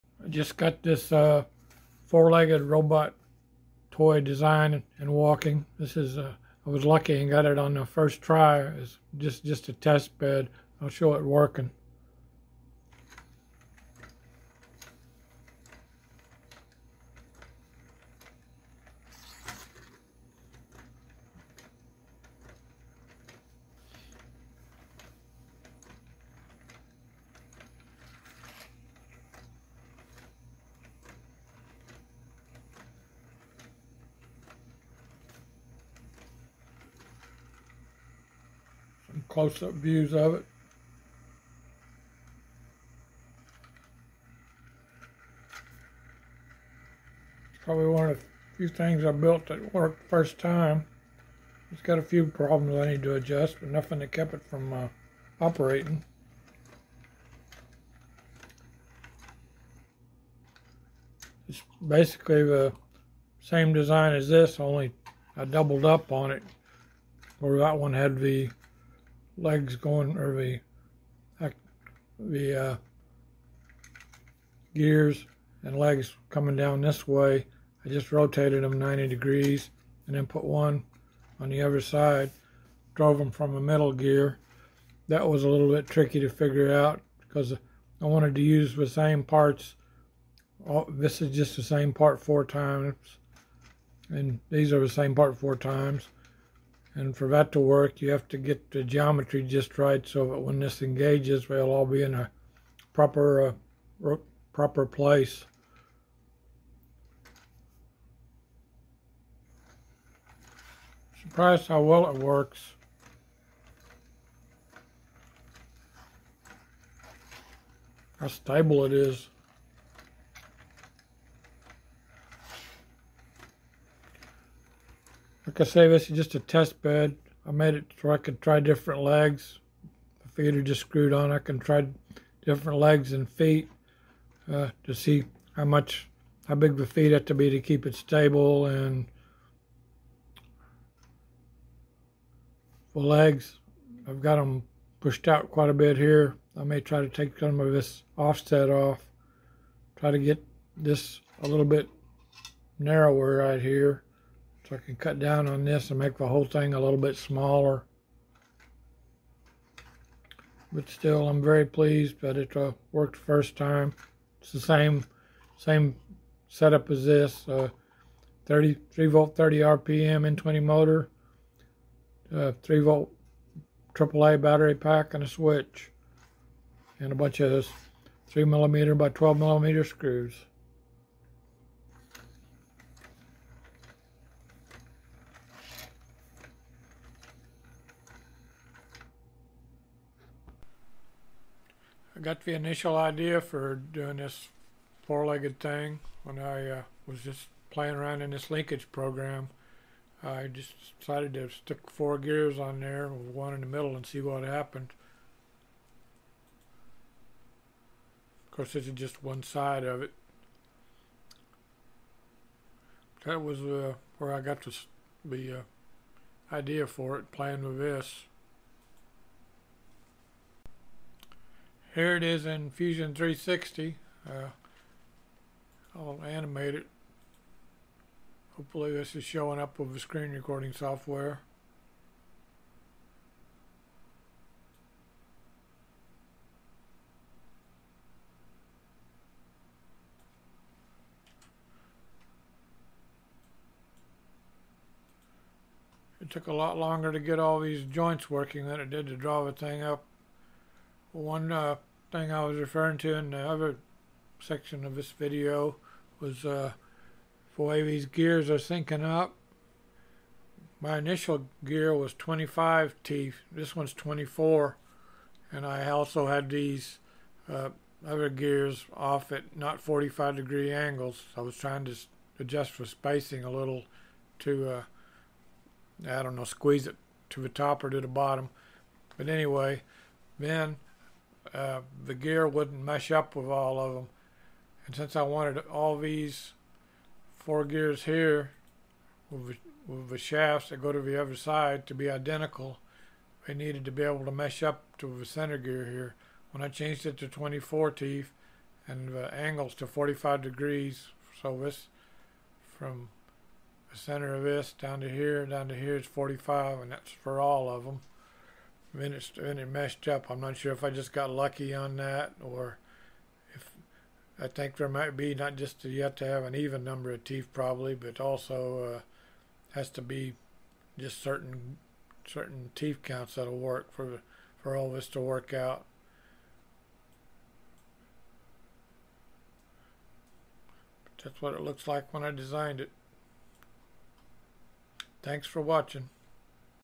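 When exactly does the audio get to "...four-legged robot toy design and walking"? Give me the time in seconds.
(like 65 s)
2 s.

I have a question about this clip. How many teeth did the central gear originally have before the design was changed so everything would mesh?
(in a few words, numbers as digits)
25.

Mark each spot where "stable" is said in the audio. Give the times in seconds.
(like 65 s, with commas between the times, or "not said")
118 s, 137 s.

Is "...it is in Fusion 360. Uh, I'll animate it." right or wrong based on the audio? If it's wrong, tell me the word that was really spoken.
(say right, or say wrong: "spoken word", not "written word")
right.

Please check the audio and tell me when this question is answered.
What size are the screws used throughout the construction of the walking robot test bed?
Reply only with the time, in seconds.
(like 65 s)
178 s.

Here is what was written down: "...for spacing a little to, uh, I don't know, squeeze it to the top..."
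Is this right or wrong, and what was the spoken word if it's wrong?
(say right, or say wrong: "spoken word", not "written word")
right.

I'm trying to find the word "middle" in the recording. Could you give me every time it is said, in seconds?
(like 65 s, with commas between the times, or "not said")
83 s, 203 s.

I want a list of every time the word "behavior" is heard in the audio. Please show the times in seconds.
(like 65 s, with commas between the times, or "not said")
not said.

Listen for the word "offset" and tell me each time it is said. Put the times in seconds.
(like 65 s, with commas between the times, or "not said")
148 s.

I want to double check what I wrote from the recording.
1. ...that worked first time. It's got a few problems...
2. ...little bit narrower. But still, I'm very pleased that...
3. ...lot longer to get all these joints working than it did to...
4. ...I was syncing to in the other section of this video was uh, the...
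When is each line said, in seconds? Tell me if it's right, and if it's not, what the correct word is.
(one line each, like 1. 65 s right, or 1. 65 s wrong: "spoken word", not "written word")
1. 49 s right
2. 156 s wrong: "smaller", not "narrower"
3. 246 s right
4. 252 s wrong: "referring", not "syncing".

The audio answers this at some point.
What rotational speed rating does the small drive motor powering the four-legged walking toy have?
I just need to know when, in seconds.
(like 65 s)
169 s.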